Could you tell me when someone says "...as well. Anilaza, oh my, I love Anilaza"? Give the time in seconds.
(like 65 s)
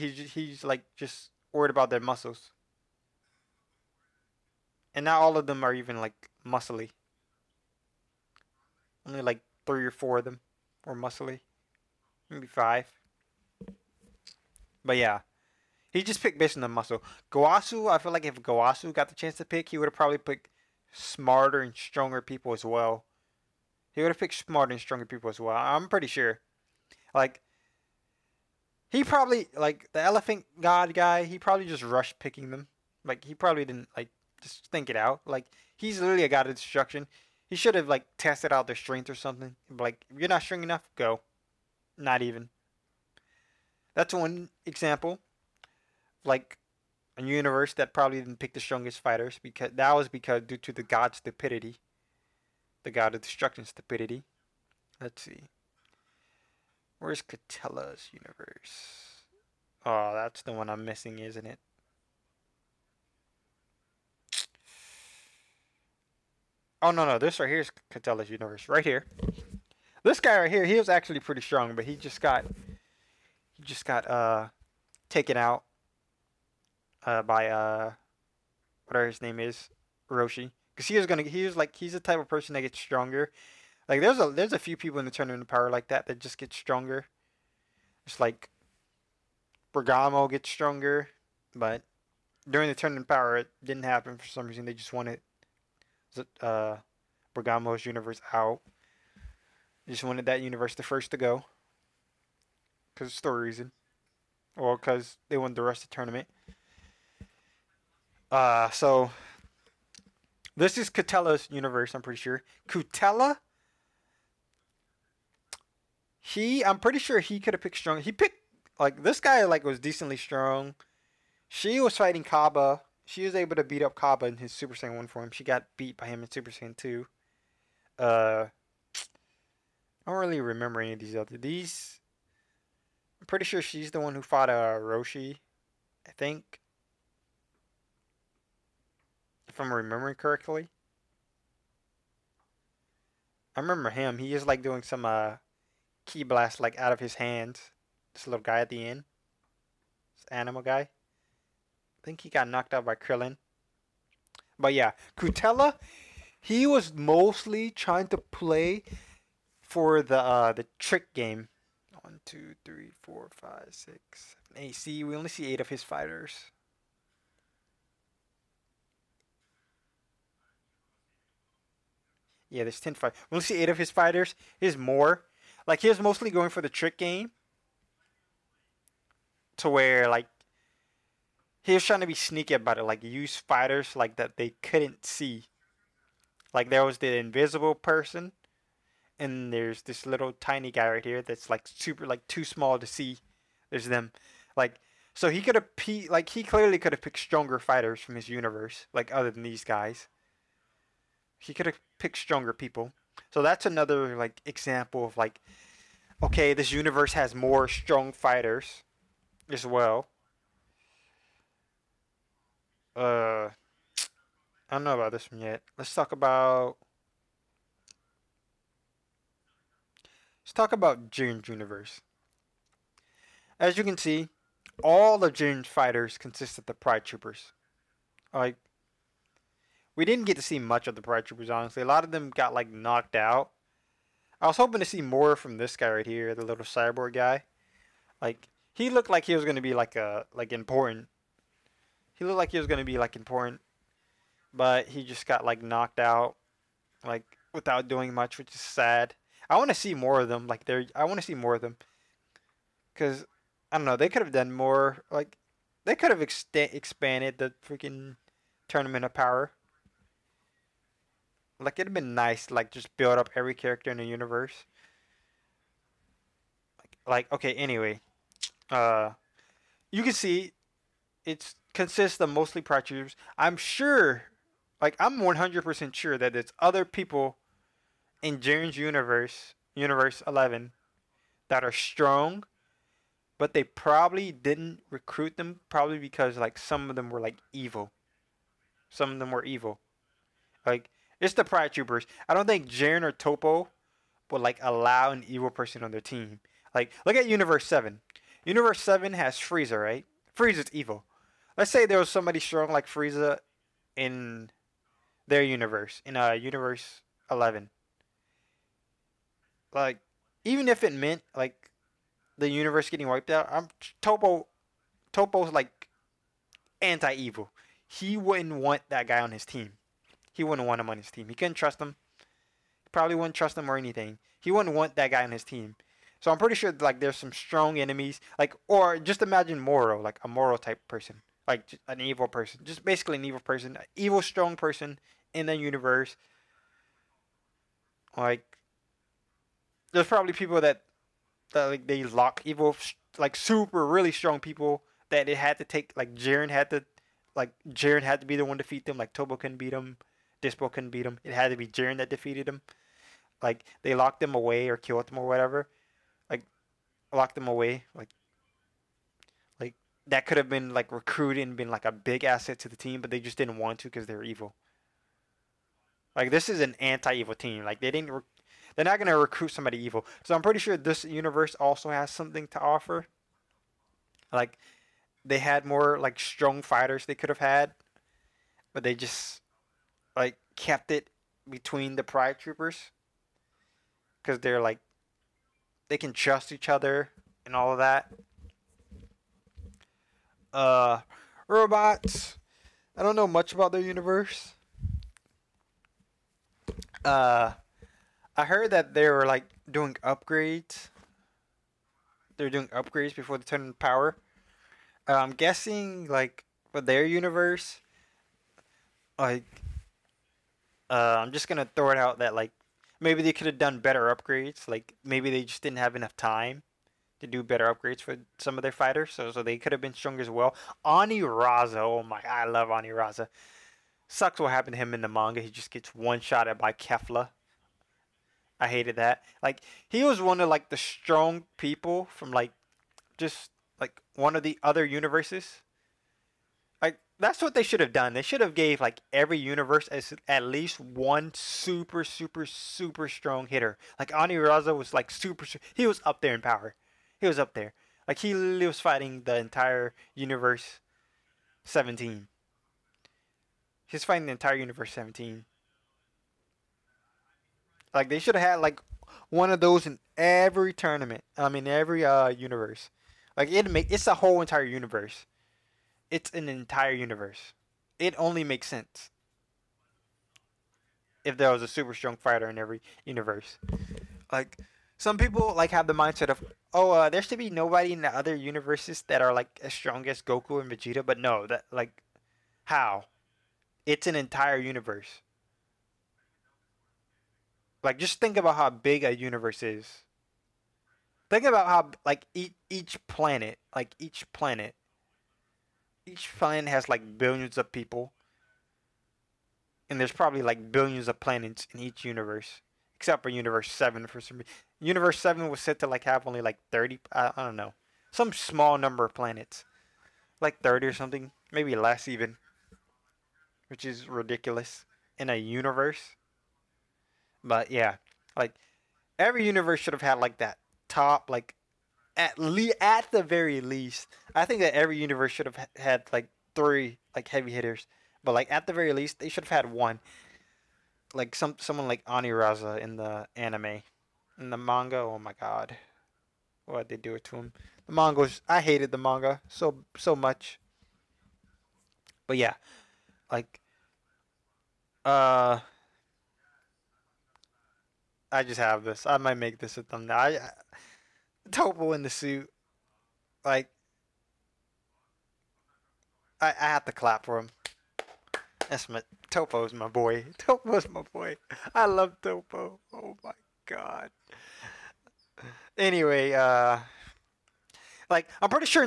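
420 s.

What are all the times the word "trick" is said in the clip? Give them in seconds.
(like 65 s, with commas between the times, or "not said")
160 s, 176 s.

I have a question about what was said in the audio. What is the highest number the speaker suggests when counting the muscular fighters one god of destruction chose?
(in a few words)
5.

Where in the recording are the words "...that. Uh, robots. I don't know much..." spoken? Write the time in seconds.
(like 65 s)
387 s.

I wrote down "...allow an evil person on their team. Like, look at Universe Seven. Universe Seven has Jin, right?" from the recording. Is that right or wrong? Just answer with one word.
wrong.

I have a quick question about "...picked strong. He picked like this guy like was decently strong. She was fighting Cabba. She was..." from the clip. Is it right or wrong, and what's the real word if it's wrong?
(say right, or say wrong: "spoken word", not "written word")
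right.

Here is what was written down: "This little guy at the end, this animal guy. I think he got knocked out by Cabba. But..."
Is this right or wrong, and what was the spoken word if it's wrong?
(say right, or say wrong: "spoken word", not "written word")
wrong: "Krillin", not "Cabba".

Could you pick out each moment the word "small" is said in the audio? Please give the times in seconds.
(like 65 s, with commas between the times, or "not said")
192 s, 508 s.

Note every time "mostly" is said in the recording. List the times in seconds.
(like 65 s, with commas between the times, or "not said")
156 s, 175 s, 272 s.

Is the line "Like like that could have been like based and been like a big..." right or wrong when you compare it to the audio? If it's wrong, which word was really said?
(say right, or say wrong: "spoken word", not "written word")
wrong: "recruited", not "based".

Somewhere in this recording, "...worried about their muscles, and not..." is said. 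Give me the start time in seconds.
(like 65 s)
1 s.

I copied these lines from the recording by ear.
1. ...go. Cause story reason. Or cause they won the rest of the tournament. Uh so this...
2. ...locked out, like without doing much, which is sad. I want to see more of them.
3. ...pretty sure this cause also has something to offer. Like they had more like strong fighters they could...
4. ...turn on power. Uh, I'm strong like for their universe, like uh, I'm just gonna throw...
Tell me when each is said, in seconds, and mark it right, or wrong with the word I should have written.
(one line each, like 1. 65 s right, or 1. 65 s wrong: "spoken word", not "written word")
1. 101 s right
2. 245 s wrong: "knocked", not "locked"
3. 370 s wrong: "universe", not "cause"
4. 403 s wrong: "guessing", not "strong".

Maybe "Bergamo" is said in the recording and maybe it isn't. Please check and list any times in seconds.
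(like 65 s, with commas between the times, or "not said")
89 s, 97 s.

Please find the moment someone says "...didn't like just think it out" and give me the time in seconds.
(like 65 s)
33 s.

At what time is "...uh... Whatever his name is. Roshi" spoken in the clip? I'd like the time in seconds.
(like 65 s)
77 s.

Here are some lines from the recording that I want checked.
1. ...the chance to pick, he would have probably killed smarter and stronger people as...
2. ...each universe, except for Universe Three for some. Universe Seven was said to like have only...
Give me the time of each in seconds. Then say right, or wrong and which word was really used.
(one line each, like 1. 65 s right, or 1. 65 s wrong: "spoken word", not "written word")
1. 19 s wrong: "picked", not "killed"
2. 501 s wrong: "Seven", not "Three".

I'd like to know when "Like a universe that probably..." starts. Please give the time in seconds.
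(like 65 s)
46 s.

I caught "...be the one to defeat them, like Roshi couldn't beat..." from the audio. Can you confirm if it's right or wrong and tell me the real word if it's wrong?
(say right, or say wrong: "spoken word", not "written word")
wrong: "Toppo", not "Roshi".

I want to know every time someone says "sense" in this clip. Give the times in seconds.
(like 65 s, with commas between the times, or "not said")
468 s.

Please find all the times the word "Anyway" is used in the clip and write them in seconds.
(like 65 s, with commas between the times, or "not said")
267 s, 565 s.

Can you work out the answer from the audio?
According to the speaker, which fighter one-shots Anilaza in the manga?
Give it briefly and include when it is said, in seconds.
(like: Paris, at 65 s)
Kefla, at 426 s.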